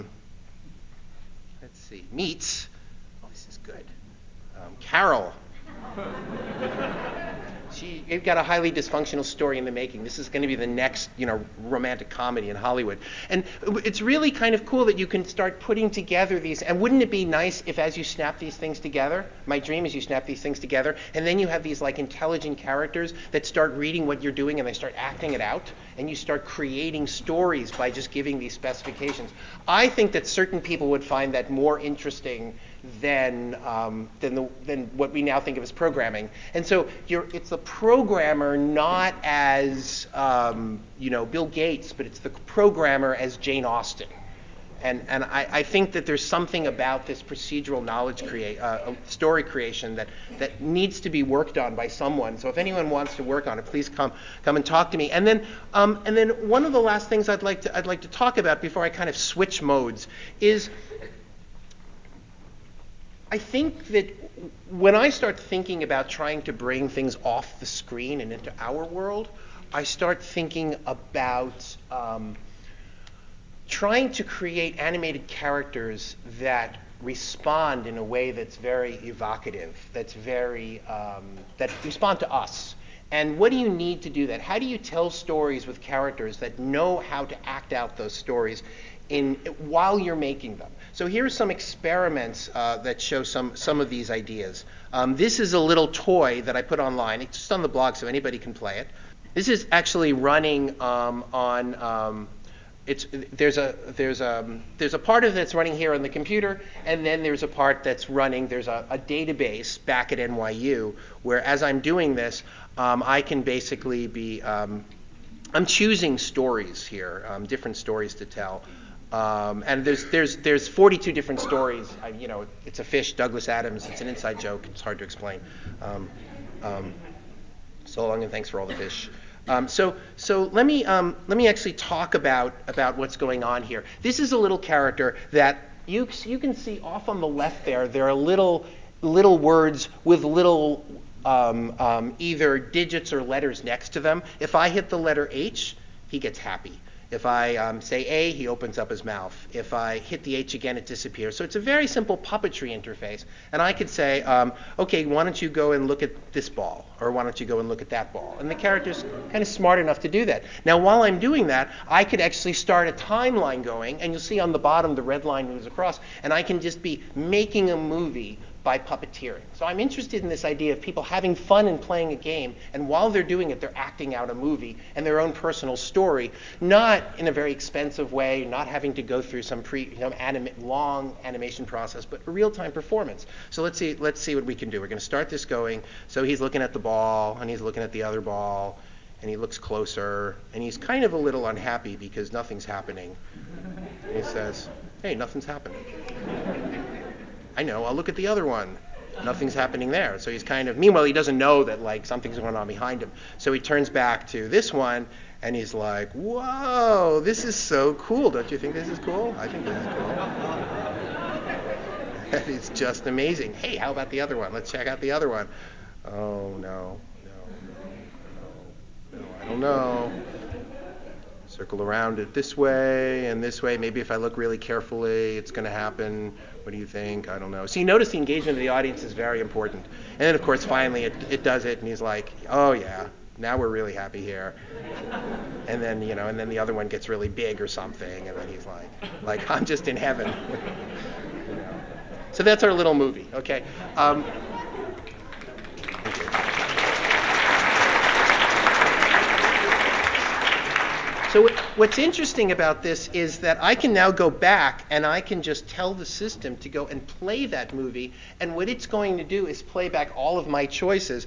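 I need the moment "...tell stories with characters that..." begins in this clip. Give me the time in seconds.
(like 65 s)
84 s.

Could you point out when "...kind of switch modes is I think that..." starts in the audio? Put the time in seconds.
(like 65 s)
58 s.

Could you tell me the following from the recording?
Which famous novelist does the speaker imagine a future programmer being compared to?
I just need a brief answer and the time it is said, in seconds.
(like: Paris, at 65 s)
Jane Austen, at 43 s.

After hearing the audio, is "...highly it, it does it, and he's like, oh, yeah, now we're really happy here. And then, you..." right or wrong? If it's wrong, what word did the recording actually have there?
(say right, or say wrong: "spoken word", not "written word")
wrong: "finally", not "highly".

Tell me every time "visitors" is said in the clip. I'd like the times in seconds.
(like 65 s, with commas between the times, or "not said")
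not said.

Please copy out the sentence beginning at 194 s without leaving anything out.
he says, "Hey, nothing's happening." I know, I'll look at the other one.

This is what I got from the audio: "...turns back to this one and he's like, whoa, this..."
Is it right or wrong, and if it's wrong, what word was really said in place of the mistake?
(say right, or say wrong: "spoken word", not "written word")
right.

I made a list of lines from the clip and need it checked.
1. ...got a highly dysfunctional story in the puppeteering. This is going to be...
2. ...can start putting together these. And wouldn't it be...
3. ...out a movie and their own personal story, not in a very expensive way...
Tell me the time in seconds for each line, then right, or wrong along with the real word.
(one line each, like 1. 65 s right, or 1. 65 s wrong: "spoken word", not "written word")
1. 8 s wrong: "making", not "puppeteering"
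2. 15 s right
3. 174 s right.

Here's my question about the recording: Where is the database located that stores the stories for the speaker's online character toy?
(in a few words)
NYU.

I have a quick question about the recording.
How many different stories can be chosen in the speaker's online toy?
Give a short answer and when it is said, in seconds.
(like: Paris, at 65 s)
42, at 120 s.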